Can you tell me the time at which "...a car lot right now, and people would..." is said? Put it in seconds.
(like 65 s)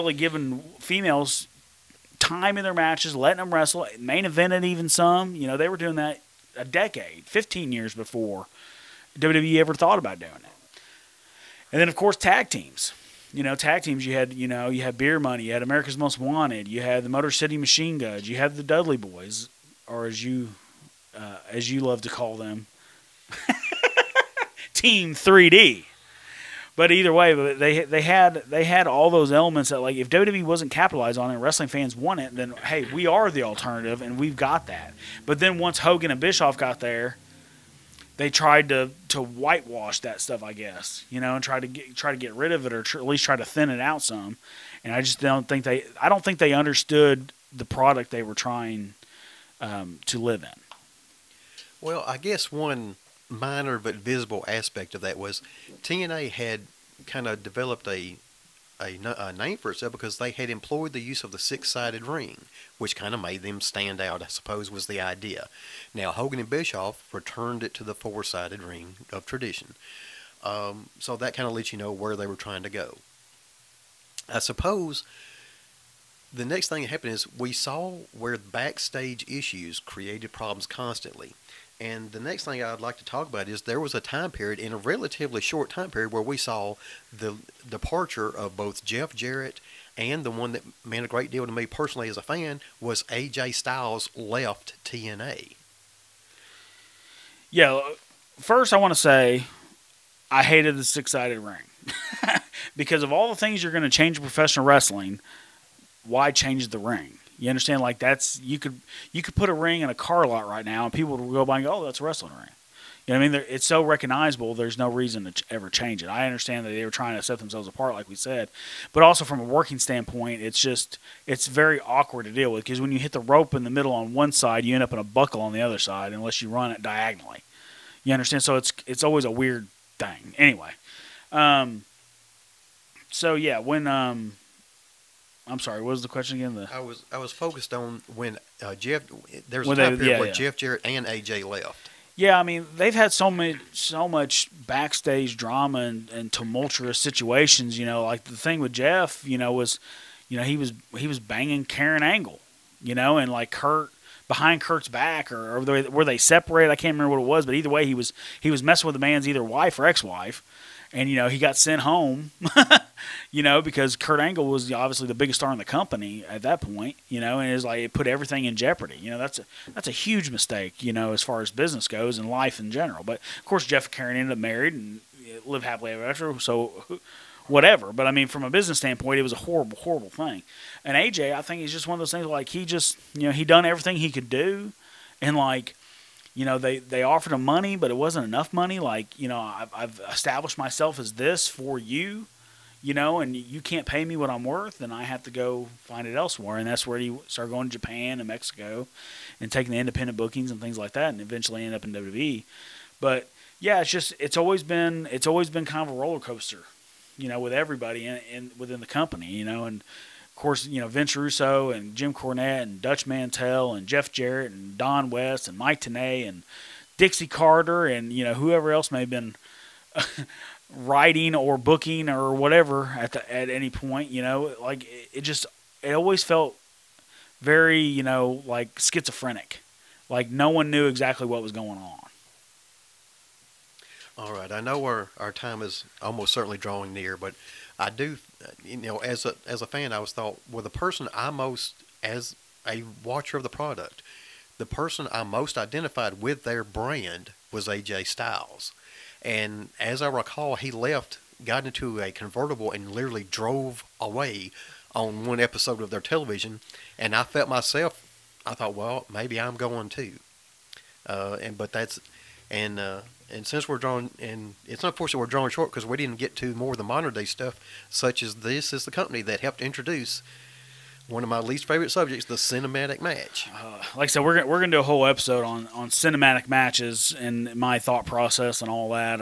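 109 s.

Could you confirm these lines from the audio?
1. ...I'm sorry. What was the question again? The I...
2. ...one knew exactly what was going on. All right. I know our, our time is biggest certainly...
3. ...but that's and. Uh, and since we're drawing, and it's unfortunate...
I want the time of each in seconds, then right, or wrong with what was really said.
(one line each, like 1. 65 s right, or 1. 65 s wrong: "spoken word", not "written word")
1. 135 s right
2. 230 s wrong: "almost", not "biggest"
3. 261 s right.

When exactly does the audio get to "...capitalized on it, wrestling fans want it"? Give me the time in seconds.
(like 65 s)
30 s.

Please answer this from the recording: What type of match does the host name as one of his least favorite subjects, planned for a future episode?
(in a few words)
cinematic match.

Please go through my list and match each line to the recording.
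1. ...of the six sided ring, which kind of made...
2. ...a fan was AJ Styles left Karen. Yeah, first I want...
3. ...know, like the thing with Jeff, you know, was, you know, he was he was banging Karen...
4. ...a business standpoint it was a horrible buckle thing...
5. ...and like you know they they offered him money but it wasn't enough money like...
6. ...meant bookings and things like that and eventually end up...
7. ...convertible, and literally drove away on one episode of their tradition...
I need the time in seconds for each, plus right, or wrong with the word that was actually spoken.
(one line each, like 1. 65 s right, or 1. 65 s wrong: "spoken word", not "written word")
1. 61 s right
2. 92 s wrong: "TNA", not "Karen"
3. 147 s right
4. 178 s wrong: "horrible", not "buckle"
5. 185 s right
6. 199 s wrong: "independent", not "meant"
7. 252 s wrong: "television", not "tradition".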